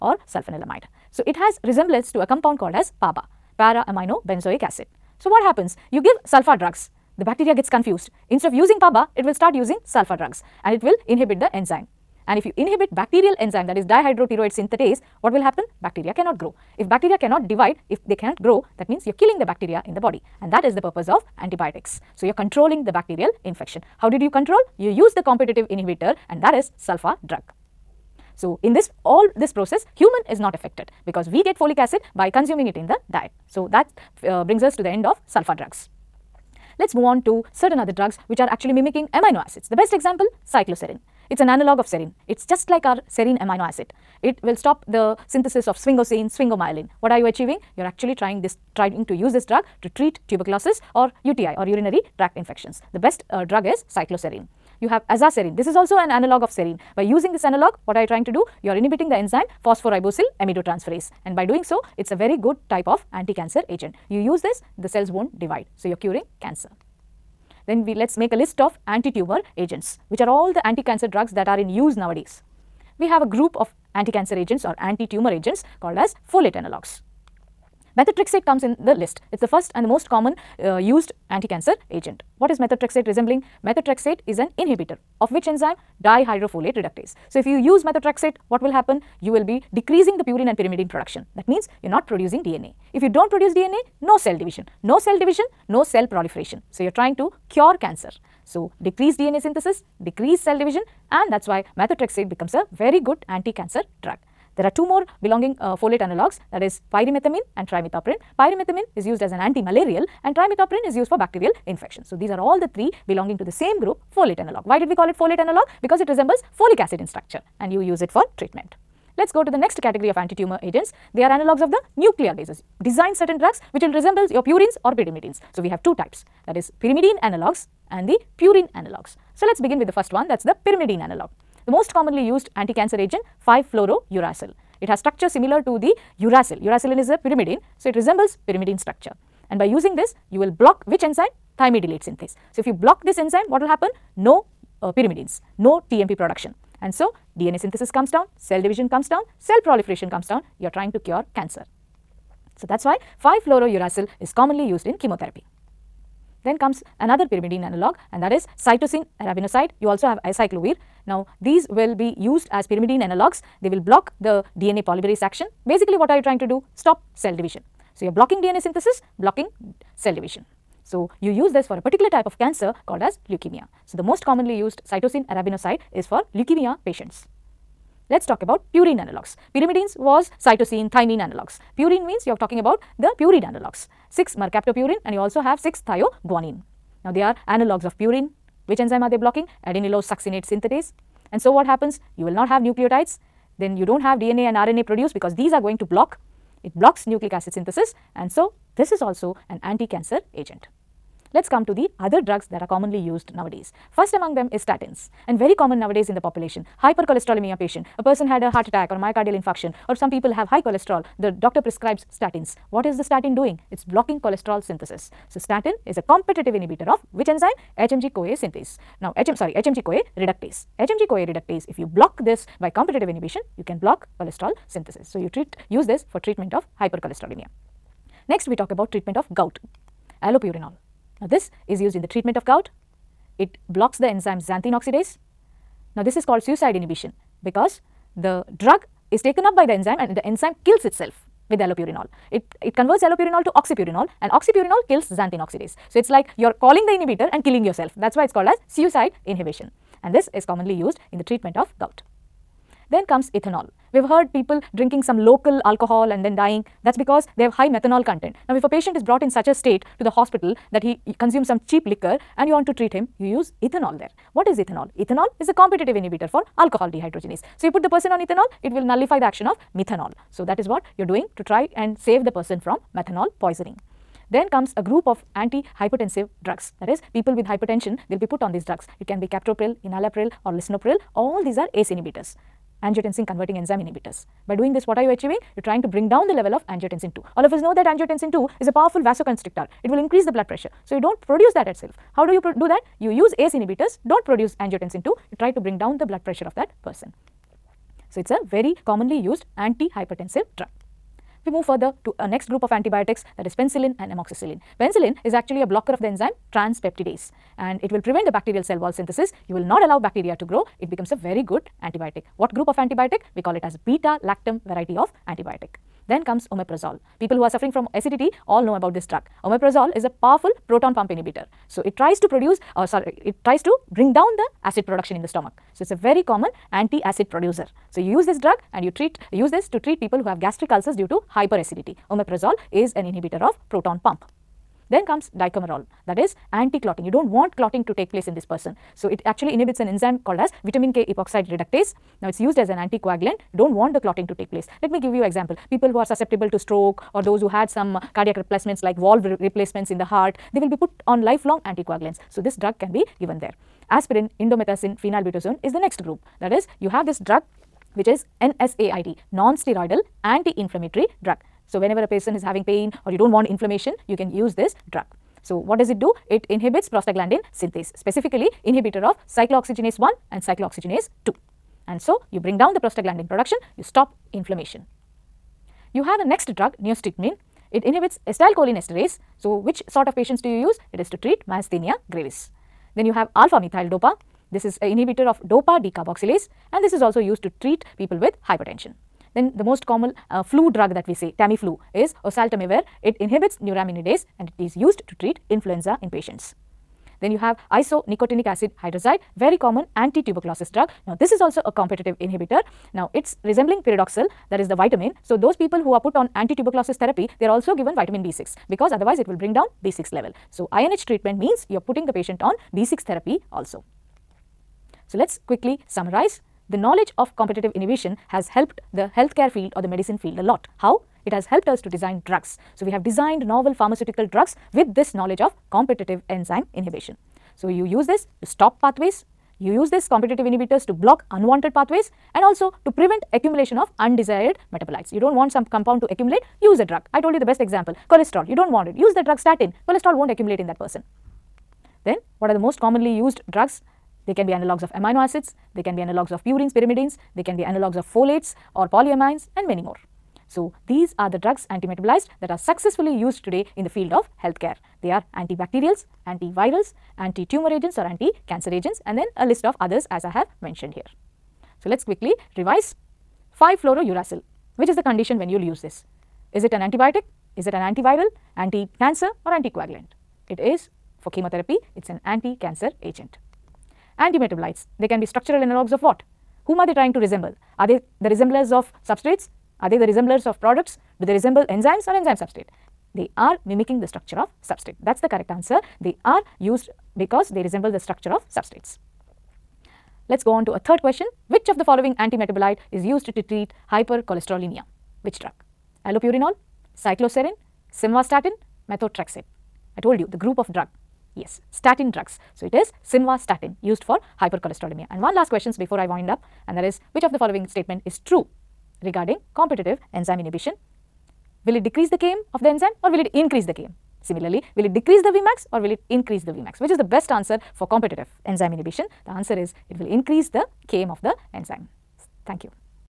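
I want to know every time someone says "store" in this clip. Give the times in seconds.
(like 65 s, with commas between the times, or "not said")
not said.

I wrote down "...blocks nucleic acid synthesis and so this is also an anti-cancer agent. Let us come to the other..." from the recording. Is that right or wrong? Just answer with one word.
right.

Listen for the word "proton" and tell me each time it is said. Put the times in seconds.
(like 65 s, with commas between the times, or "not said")
320 s, 333 s.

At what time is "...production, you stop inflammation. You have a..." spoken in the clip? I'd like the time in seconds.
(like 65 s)
373 s.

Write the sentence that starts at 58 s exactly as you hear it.
You are inhibiting the enzyme phosphoribosyl amidotransferase and by doing so, it is a very good type of anti-cancer agent.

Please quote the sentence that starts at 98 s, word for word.
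So, decrease DNA synthesis, decrease cell division and that is why methotrexate becomes a very good anti-cancer drug.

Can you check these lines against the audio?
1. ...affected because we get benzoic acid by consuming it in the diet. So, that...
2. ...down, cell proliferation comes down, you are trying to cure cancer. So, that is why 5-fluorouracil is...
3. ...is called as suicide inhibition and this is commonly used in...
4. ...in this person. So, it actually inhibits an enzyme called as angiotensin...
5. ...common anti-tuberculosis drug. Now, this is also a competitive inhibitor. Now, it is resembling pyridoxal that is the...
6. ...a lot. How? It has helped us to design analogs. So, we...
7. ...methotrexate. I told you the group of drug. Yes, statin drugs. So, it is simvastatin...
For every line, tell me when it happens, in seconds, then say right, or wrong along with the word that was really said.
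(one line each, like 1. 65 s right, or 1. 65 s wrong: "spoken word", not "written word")
1. 30 s wrong: "folic", not "benzoic"
2. 149 s right
3. 248 s right
4. 338 s wrong: "vitamin", not "angiotensin"
5. 399 s right
6. 420 s wrong: "drugs", not "analogs"
7. 498 s right.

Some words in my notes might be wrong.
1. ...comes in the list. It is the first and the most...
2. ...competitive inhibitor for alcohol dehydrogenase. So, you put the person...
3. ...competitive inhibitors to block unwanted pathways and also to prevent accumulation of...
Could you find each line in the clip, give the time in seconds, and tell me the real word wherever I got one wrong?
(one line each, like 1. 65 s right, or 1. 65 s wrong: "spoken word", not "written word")
1. 78 s right
2. 265 s right
3. 430 s right.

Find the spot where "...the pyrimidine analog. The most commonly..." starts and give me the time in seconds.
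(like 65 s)
130 s.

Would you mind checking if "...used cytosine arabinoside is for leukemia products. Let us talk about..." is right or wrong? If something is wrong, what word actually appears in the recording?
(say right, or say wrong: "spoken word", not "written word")
wrong: "patients", not "products".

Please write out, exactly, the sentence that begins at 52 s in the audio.
The best uh, drug is cycloserine you have azaserine.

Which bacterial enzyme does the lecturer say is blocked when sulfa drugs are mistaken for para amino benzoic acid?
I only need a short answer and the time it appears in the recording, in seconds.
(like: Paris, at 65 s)
Dihydropteroate synthetase, at 13 s.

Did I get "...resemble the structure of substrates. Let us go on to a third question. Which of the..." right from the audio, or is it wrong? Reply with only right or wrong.
right.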